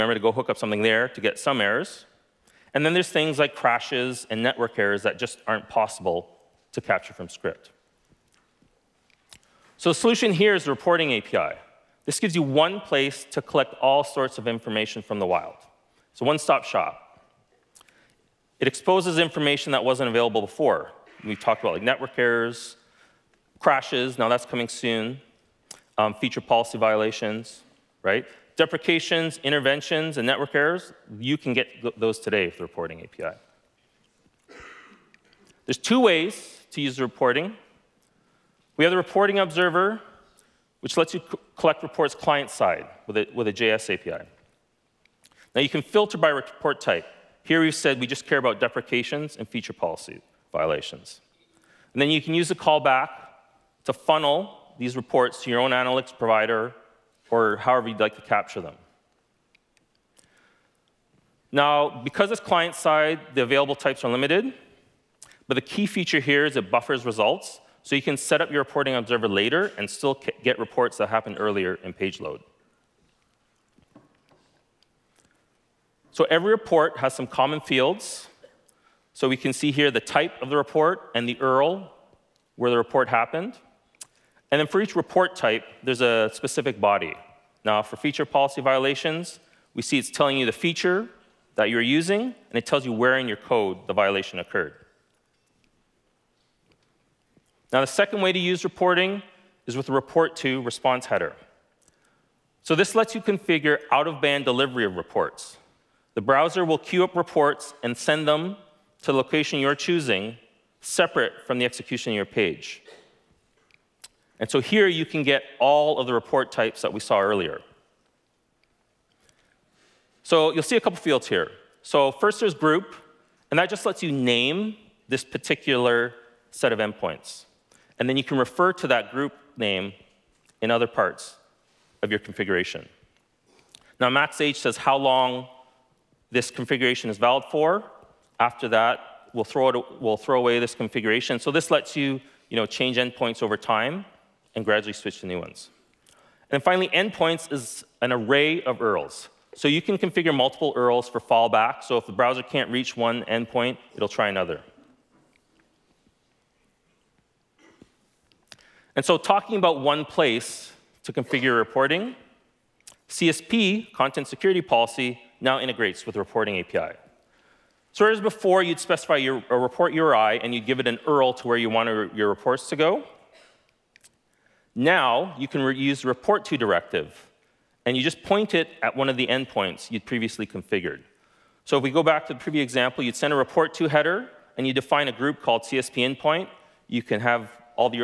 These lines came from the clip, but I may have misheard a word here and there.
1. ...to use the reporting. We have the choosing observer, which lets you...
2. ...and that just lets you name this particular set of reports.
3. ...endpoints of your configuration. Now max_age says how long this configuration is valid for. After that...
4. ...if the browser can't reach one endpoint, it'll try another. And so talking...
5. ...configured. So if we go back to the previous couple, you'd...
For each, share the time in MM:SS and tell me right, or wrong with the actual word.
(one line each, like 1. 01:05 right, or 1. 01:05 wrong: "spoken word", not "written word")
1. 00:36 wrong: "reporting", not "choosing"
2. 02:03 wrong: "endpoints", not "reports"
3. 02:10 wrong: "parts", not "endpoints"
4. 02:31 right
5. 03:00 wrong: "example", not "couple".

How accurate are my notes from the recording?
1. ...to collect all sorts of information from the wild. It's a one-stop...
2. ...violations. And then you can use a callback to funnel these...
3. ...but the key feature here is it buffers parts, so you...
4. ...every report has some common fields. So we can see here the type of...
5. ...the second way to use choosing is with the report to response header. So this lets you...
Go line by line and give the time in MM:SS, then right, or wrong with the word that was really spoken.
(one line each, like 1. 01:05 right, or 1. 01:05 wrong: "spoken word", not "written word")
1. 00:13 right
2. 00:50 right
3. 01:05 wrong: "results", not "parts"
4. 01:16 right
5. 01:37 wrong: "reporting", not "choosing".